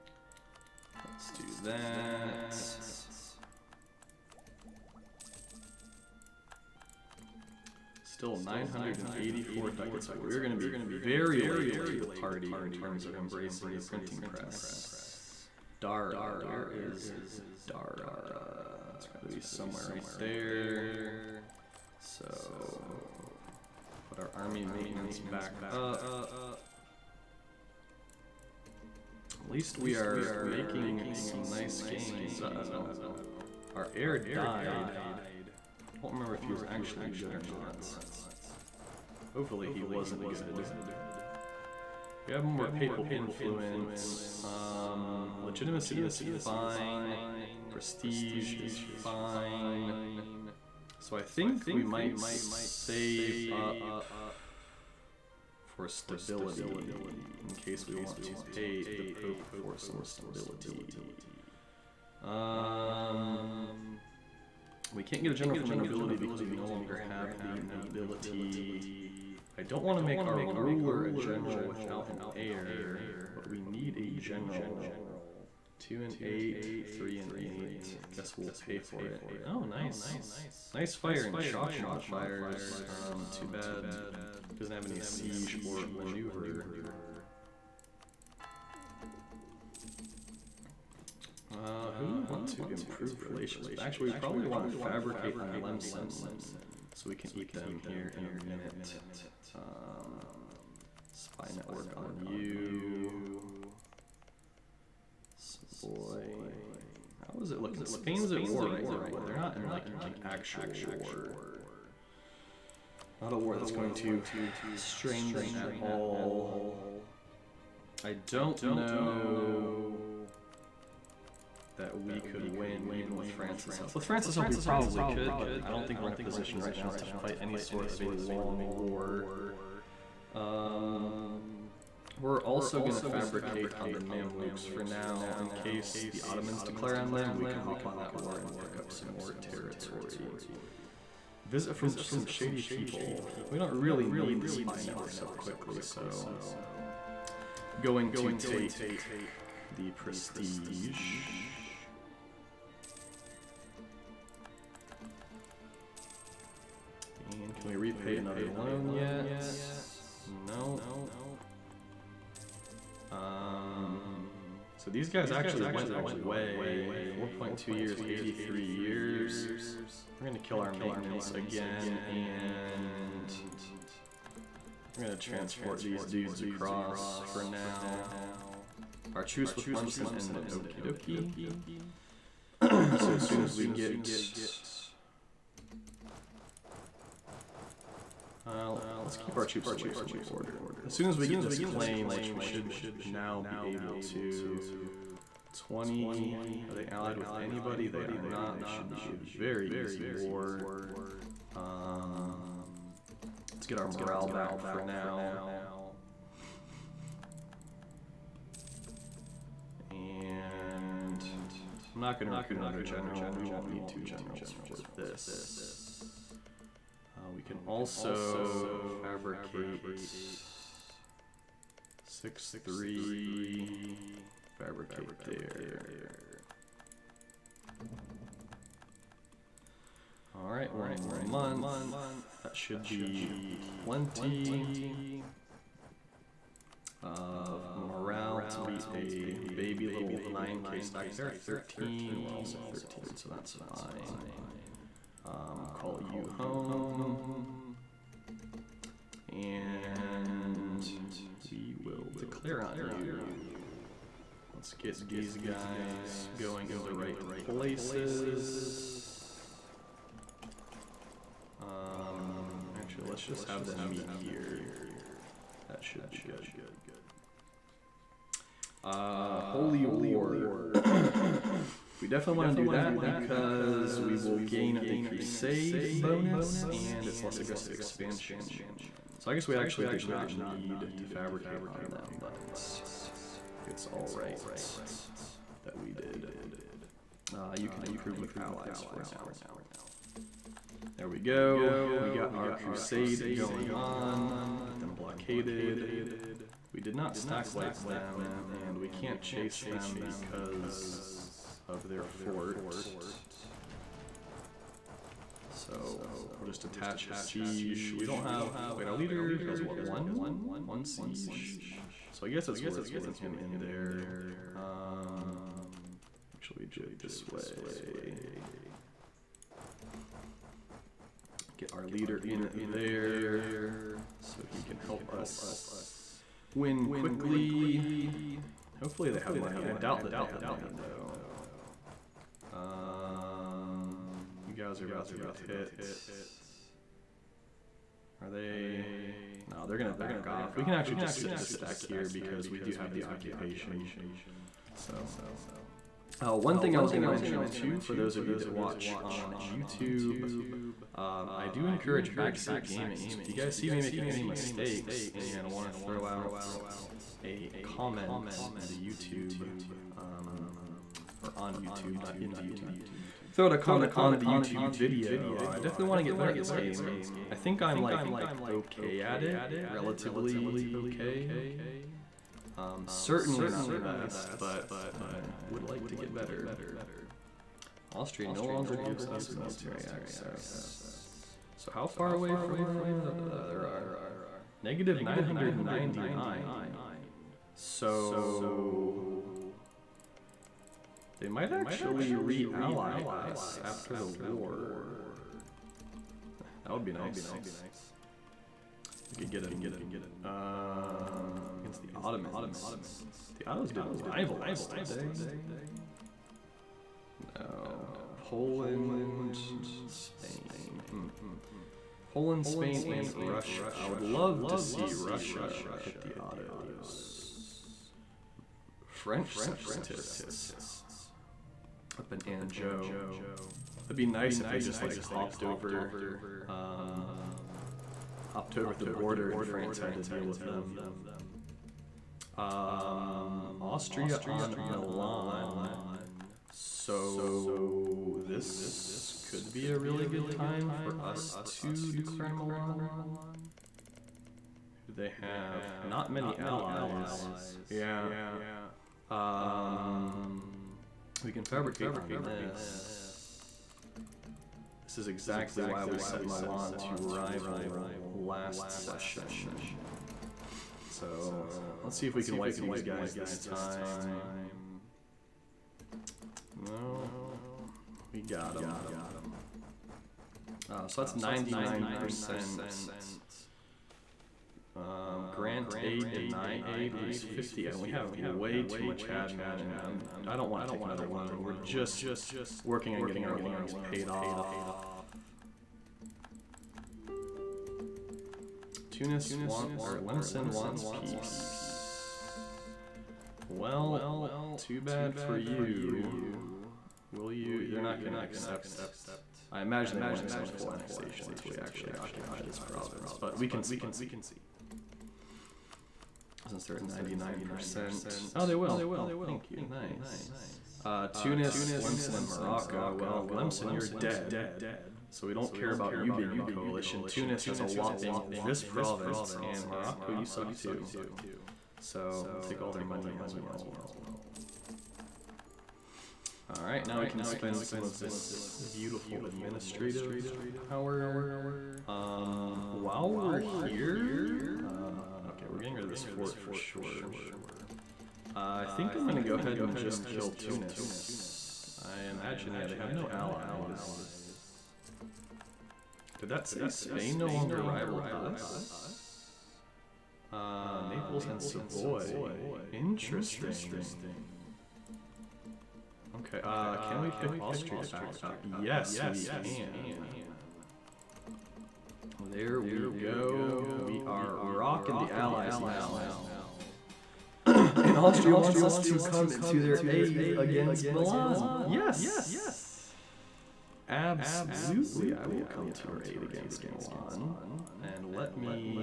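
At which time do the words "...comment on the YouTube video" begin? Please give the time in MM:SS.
06:03.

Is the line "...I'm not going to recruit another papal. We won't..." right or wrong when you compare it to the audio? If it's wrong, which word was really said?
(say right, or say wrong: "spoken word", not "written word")
wrong: "general", not "papal".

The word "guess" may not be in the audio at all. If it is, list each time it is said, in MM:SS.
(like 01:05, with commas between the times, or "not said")
01:18, 04:39, 05:12.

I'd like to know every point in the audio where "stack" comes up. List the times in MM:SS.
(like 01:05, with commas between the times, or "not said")
04:00, 04:57, 05:41.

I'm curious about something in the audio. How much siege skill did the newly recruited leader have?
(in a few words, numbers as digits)
1.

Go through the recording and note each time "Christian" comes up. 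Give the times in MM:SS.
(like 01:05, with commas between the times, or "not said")
not said.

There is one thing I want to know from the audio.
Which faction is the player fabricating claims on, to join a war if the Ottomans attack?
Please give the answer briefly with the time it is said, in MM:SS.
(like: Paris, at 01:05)
Mamluks, at 02:13.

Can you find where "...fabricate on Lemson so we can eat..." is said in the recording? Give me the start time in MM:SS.
01:34.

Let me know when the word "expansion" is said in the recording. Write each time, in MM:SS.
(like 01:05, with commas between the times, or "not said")
04:37.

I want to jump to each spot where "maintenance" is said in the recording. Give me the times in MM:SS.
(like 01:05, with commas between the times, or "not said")
00:24, 02:50.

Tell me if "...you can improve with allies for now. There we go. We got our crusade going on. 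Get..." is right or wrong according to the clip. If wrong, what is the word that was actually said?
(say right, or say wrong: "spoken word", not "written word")
right.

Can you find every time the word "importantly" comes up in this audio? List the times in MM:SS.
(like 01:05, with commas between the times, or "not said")
not said.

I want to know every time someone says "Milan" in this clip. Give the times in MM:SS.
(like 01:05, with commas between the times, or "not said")
07:14, 07:22, 07:36, 09:30, 09:36.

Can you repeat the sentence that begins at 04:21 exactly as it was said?
Um, actually, let's just have them meet here.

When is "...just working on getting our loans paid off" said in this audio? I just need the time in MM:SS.
08:01.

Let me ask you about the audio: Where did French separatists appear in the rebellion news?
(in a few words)
Anjou.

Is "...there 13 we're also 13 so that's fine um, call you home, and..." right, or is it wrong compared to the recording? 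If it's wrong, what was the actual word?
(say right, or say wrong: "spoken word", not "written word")
right.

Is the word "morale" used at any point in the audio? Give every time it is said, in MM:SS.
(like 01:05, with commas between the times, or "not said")
03:23, 03:57.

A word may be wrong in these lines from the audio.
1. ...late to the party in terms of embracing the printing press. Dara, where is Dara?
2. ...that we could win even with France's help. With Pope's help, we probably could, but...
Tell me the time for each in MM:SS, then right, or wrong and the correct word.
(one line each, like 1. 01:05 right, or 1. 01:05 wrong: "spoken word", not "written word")
1. 00:11 right
2. 02:01 wrong: "France", not "Pope".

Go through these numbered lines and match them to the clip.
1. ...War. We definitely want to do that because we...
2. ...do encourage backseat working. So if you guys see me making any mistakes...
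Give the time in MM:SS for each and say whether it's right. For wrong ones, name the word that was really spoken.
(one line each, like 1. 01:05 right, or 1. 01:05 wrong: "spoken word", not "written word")
1. 04:29 right
2. 05:51 wrong: "gaming", not "working".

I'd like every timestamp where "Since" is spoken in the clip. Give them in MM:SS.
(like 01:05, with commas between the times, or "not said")
08:26.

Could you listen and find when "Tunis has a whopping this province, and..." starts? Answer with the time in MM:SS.
08:37.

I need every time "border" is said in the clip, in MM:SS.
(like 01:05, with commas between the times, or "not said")
03:10, 07:08.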